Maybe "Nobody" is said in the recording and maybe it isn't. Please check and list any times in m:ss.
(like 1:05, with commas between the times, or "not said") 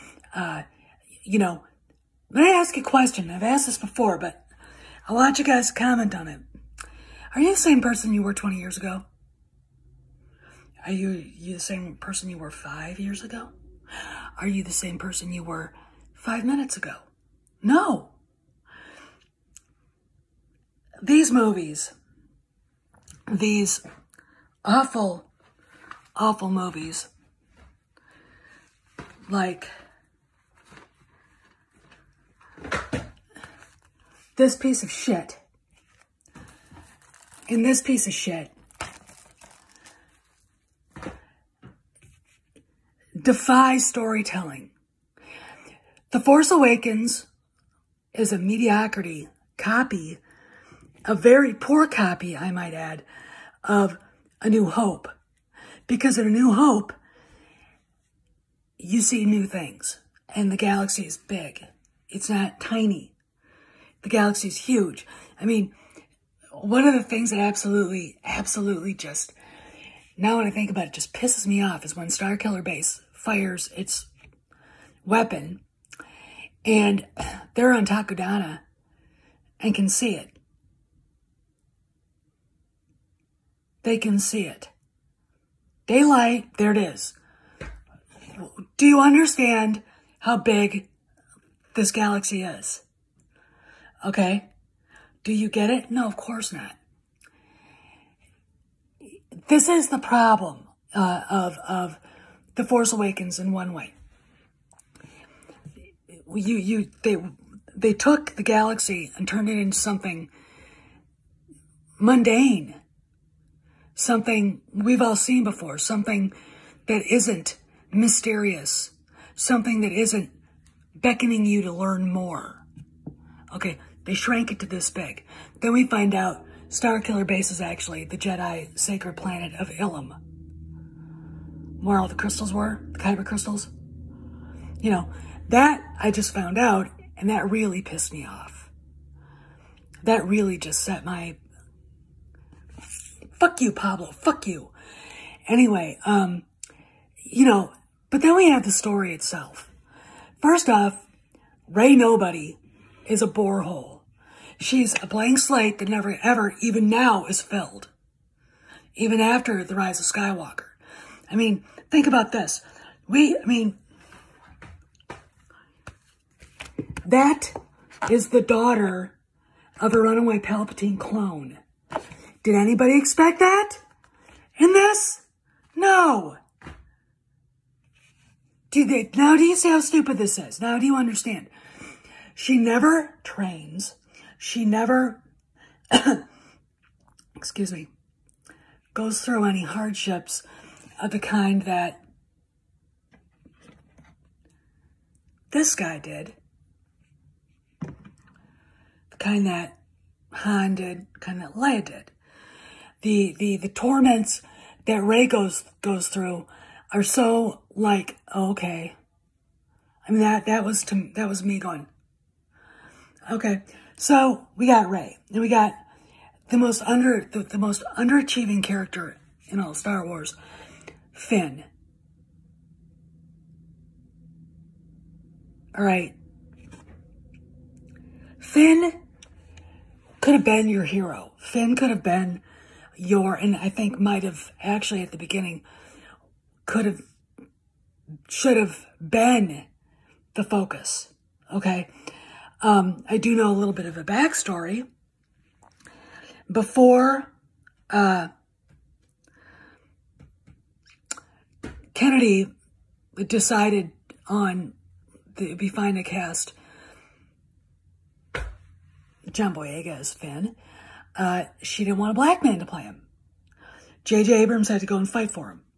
2:31.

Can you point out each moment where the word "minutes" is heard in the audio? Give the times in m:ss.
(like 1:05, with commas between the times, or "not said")
0:16.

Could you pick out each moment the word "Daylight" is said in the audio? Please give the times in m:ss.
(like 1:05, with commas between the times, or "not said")
1:25.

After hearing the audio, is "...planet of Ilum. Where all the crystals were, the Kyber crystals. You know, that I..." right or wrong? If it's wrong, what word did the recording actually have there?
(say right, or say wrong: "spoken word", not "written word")
right.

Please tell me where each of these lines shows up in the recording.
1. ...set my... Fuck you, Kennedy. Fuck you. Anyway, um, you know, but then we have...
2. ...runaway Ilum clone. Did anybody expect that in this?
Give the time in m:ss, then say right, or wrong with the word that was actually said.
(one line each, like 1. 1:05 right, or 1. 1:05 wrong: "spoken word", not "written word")
1. 2:20 wrong: "Pablo", not "Kennedy"
2. 2:50 wrong: "Palpatine", not "Ilum".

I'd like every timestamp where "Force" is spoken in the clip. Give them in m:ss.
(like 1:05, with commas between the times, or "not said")
0:46, 1:42.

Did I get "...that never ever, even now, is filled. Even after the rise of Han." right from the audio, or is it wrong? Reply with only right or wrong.
wrong.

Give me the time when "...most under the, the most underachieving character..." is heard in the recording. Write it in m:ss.
3:36.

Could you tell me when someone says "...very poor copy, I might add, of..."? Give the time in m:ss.
0:51.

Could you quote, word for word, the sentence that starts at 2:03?
Okay, they shrank it to this big.